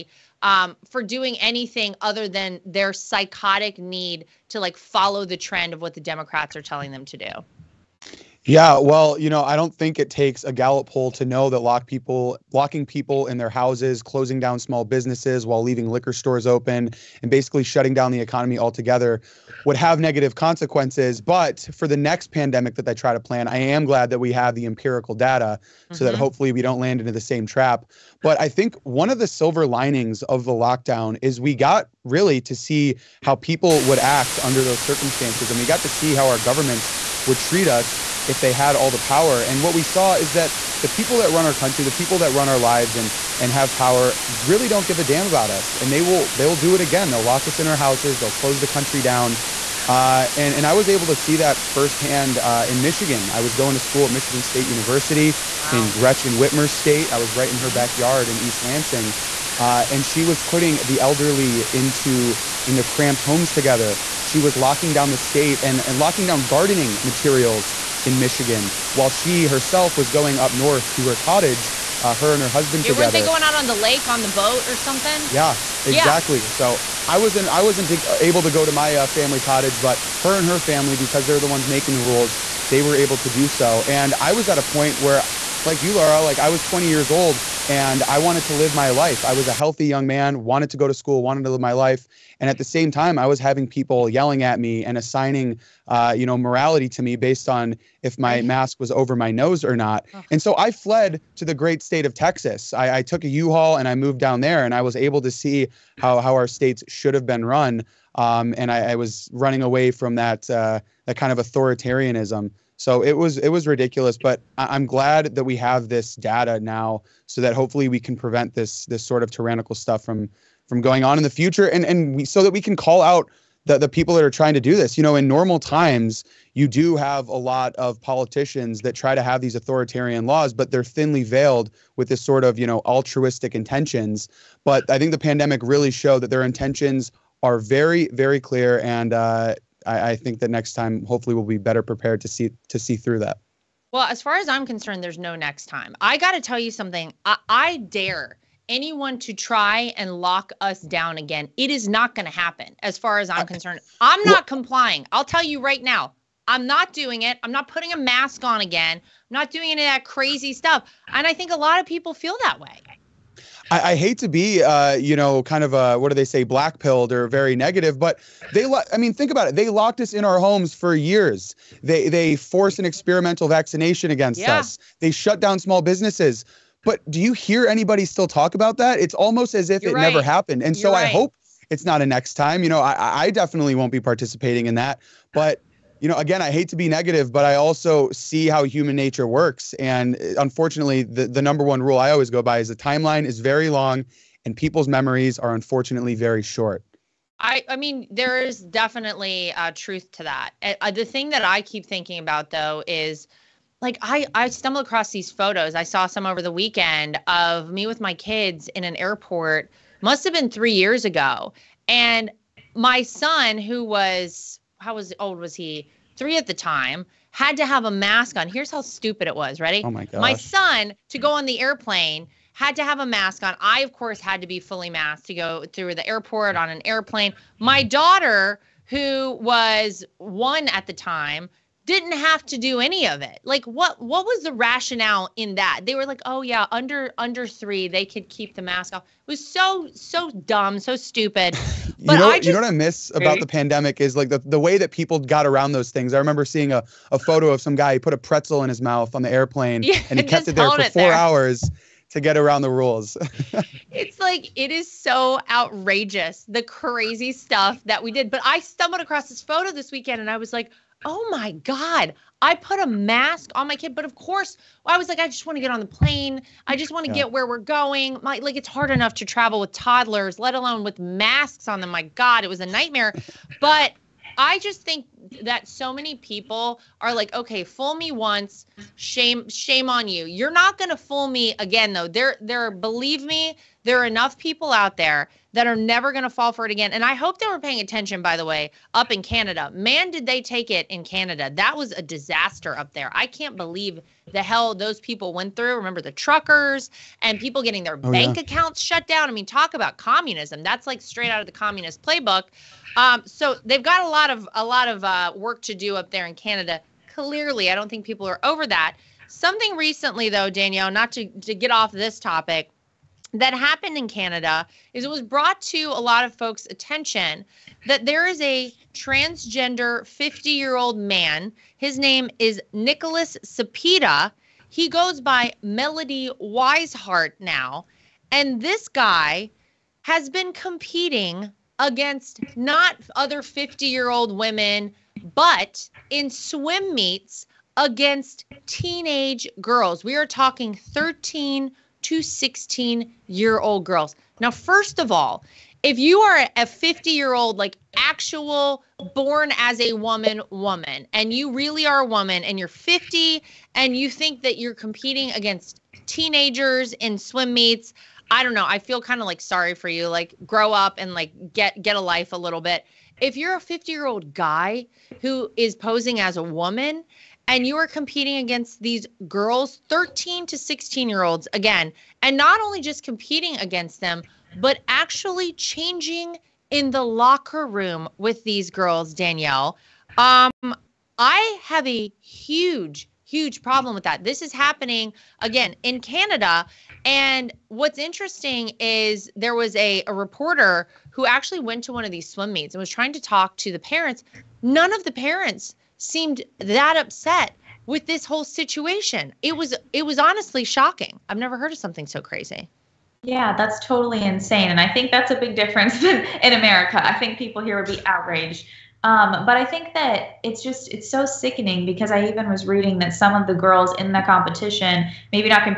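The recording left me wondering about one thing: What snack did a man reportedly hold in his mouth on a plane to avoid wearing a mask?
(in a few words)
A pretzel.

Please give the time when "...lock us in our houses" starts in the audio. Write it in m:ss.
0:47.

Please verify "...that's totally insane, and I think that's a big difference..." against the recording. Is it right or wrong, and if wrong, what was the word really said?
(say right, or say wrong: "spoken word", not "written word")
right.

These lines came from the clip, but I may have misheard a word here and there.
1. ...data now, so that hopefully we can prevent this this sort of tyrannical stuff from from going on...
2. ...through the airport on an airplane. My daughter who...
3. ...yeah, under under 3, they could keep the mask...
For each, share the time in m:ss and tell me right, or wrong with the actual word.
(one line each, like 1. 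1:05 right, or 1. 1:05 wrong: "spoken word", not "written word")
1. 1:56 right
2. 3:45 right
3. 3:56 right.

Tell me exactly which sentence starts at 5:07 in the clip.
Clearly, I don't think people are over that.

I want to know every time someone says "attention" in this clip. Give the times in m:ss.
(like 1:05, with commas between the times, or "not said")
4:47, 5:16.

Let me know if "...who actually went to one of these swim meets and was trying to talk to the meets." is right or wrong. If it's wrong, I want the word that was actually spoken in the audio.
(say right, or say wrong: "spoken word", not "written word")
wrong: "parents", not "meets".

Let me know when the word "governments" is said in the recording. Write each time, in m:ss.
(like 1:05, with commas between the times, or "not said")
0:36.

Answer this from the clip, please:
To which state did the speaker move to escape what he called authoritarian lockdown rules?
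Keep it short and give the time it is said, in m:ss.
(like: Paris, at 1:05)
Texas, at 1:42.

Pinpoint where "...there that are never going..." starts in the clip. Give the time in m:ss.
4:44.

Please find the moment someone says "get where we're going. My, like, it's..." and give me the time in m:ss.
4:27.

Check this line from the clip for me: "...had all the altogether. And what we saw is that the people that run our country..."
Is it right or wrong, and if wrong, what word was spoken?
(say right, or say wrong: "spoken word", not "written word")
wrong: "power", not "altogether".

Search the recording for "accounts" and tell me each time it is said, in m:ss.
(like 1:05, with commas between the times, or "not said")
4:58.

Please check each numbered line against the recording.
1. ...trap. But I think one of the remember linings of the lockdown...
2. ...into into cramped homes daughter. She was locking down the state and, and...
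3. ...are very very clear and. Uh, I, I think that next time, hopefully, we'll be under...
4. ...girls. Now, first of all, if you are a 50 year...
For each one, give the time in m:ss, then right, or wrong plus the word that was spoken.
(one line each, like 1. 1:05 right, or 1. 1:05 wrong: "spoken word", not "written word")
1. 0:27 wrong: "silver", not "remember"
2. 1:01 wrong: "together", not "daughter"
3. 2:17 wrong: "better", not "under"
4. 5:43 right.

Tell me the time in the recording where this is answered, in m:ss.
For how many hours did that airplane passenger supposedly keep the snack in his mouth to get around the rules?
4:10.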